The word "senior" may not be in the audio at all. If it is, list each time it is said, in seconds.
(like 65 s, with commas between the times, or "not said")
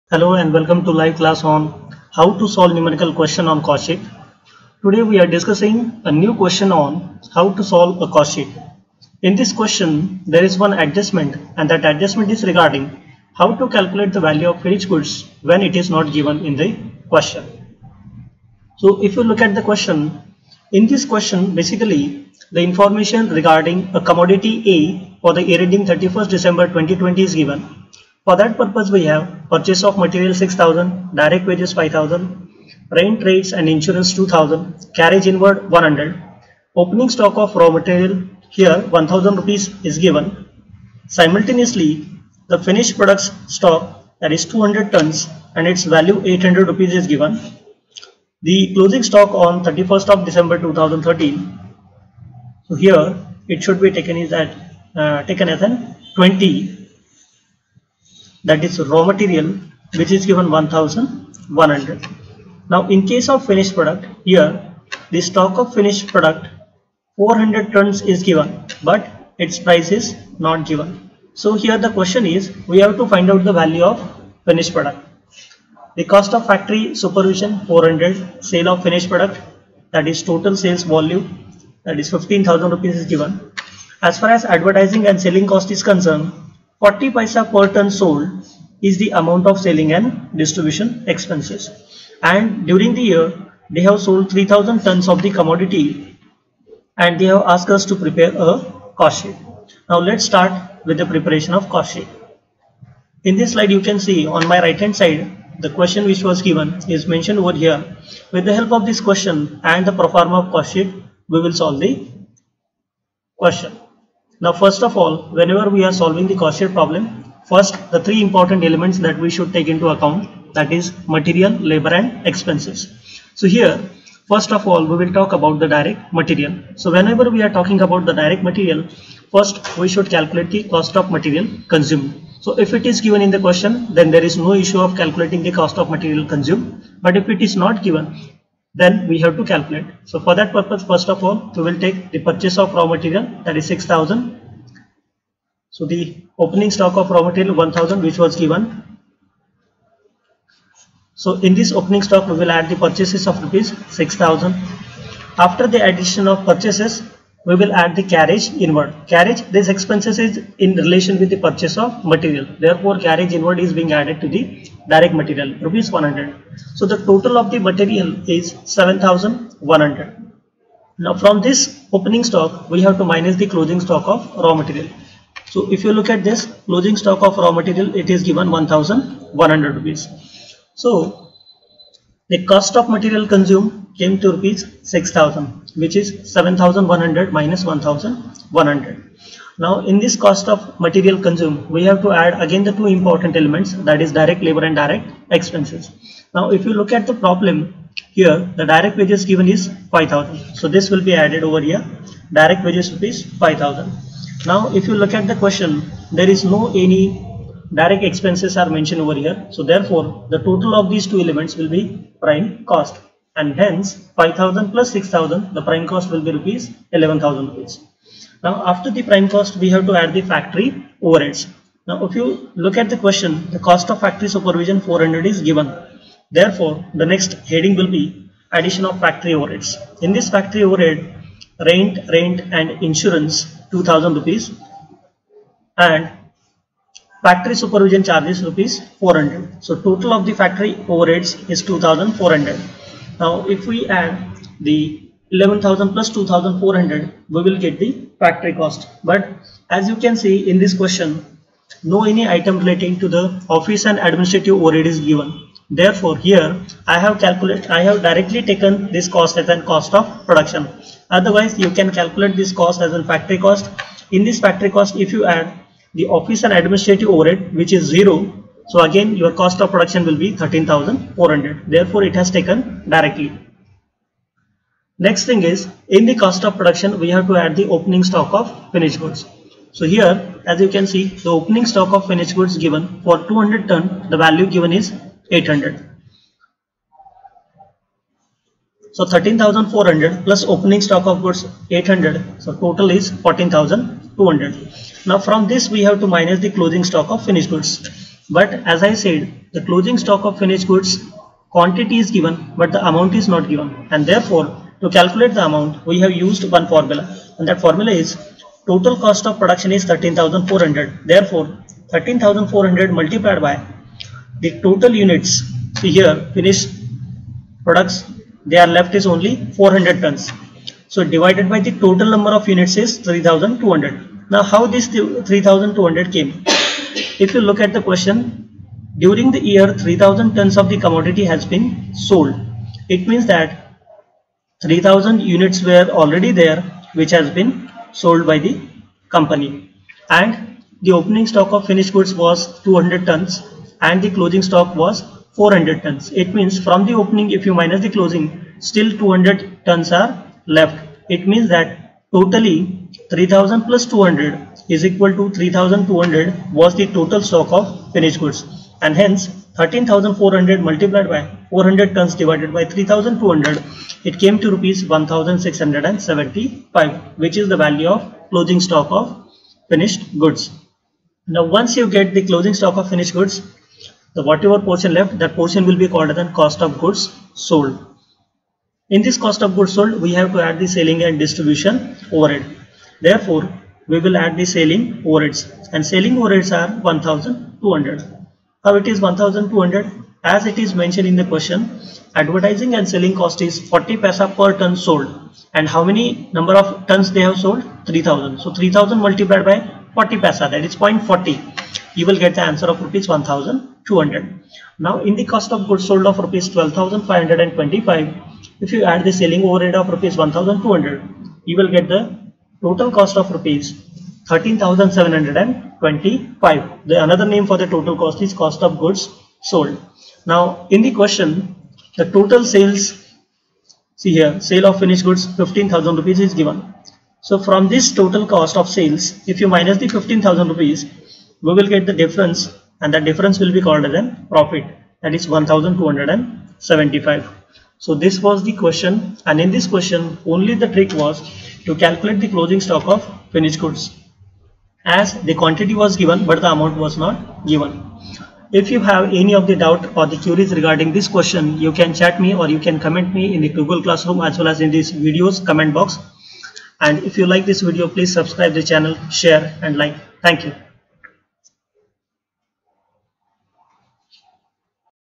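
not said.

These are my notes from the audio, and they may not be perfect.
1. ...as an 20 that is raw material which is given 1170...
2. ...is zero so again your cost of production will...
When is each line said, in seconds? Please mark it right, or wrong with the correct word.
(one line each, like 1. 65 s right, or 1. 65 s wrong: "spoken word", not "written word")
1. 55 s wrong: "1100", not "1170"
2. 267 s right.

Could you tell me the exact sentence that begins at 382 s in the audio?
Therefore, we will add the selling overheads and selling overheads are 1200.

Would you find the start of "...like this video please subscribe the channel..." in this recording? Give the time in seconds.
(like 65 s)
457 s.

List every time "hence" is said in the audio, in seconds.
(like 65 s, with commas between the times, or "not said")
213 s, 358 s.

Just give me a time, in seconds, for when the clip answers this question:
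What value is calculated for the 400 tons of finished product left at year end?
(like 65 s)
364 s.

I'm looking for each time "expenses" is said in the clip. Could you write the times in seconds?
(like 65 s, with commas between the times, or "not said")
91 s, 122 s, 159 s, 195 s, 208 s.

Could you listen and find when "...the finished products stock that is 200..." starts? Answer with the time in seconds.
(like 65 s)
42 s.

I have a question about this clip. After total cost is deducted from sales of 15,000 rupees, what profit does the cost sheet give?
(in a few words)
1275.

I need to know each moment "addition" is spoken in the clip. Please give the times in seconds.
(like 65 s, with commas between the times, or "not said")
155 s, 228 s.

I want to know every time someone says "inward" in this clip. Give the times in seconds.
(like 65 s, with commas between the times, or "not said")
35 s, 158 s, 163 s.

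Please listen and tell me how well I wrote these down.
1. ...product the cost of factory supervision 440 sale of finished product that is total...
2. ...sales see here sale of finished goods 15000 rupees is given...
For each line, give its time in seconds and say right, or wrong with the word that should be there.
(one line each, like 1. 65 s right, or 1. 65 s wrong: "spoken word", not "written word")
1. 74 s wrong: "400", not "440"
2. 422 s right.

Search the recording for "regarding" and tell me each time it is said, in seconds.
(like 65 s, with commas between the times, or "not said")
12 s, 23 s, 450 s.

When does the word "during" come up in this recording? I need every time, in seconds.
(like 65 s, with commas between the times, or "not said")
92 s, 328 s.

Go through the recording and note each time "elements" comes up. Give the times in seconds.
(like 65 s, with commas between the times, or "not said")
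118 s, 193 s, 211 s.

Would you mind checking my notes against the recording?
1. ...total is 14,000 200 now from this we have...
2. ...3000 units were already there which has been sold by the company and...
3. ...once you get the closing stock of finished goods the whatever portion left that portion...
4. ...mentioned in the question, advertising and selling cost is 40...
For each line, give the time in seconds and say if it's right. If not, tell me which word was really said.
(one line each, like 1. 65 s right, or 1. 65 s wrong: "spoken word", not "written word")
1. 292 s right
2. 334 s right
3. 371 s right
4. 390 s right.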